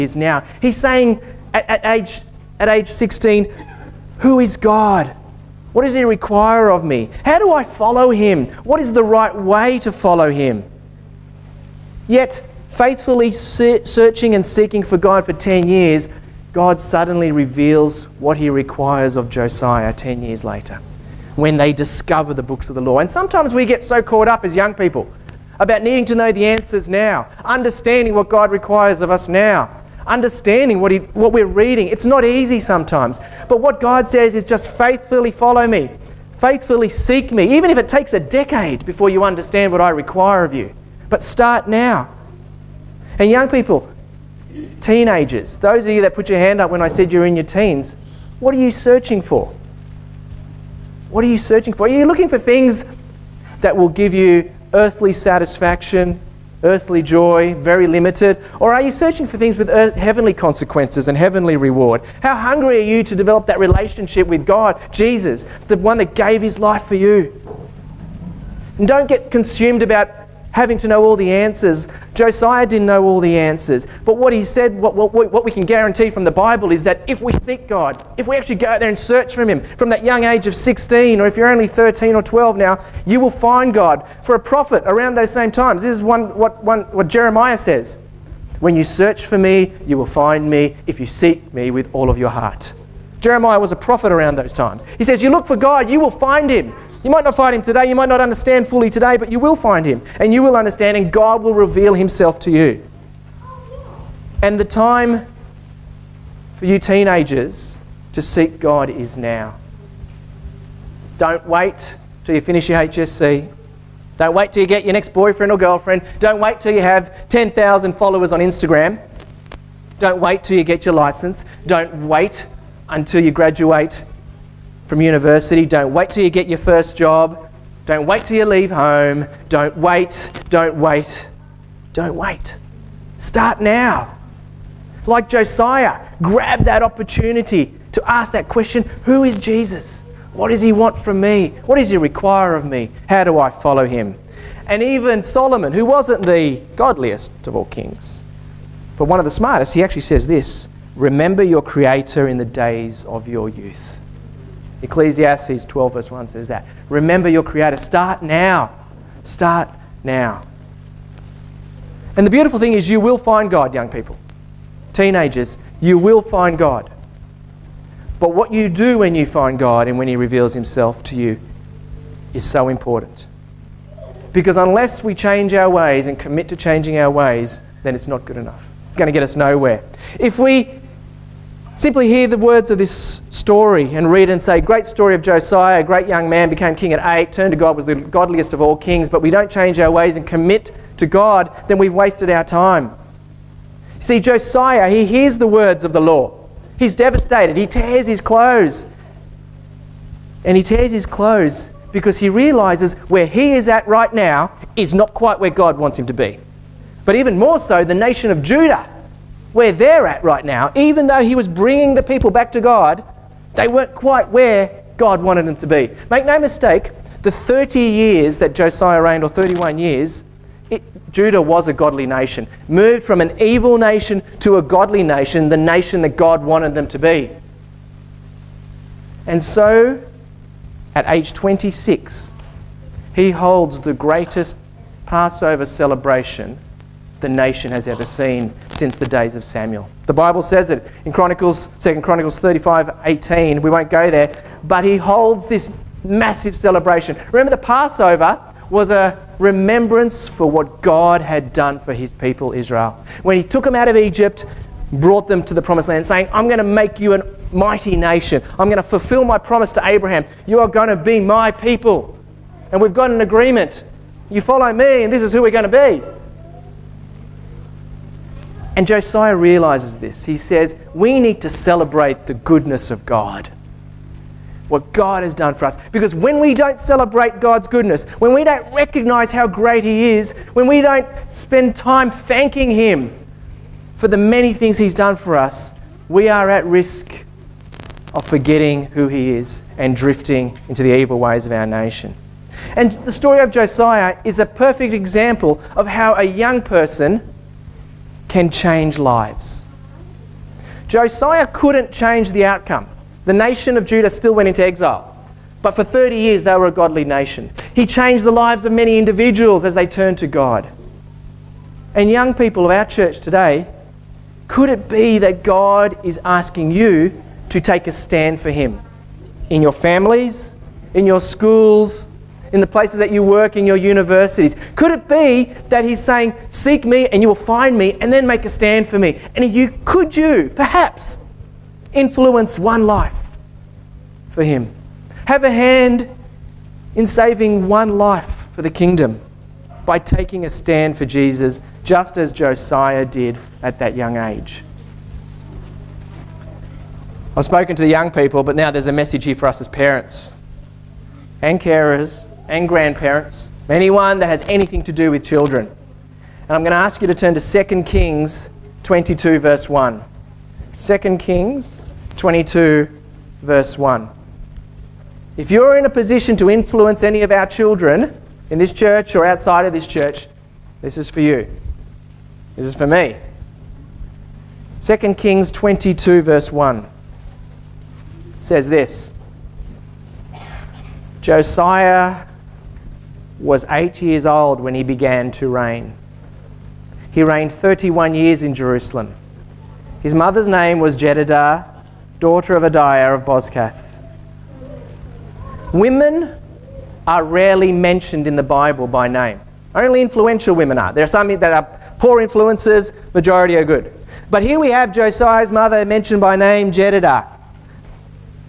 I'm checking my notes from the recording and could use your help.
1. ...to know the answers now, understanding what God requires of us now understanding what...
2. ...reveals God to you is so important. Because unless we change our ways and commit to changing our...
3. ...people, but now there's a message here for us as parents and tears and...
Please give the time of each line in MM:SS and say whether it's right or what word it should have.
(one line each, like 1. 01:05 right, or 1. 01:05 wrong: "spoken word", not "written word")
1. 00:26 right
2. 02:50 wrong: "Himself", not "God"
3. 05:48 wrong: "carers", not "tears".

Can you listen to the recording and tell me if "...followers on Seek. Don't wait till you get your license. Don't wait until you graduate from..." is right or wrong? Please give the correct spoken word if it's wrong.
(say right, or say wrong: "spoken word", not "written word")
wrong: "Instagram", not "Seek".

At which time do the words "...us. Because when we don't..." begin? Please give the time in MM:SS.
04:35.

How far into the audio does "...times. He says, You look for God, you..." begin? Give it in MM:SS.
01:34.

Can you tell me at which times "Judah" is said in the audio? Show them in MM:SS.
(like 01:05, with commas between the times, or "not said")
03:28, 03:41, 05:03.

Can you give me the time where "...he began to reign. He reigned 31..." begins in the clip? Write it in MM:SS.
06:24.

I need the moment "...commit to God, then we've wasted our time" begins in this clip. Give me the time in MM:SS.
03:10.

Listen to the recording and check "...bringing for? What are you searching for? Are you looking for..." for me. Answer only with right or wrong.
wrong.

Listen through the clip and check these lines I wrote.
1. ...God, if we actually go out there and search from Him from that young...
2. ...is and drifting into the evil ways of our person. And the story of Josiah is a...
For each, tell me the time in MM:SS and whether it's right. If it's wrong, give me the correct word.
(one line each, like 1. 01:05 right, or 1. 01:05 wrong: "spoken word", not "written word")
1. 01:17 right
2. 04:49 wrong: "nation", not "person".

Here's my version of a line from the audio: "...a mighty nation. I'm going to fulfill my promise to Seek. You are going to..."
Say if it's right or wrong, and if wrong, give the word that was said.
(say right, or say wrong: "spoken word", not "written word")
wrong: "Abraham", not "Seek".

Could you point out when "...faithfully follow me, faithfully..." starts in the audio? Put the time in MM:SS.
00:34.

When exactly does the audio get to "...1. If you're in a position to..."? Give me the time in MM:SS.
06:03.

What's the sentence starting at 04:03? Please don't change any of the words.
We won't go there, but he holds this massive celebration.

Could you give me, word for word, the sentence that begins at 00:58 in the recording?
Or are you searching for things with earth, heavenly consequences and heavenly reward?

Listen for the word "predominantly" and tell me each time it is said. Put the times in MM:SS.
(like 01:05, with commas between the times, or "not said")
not said.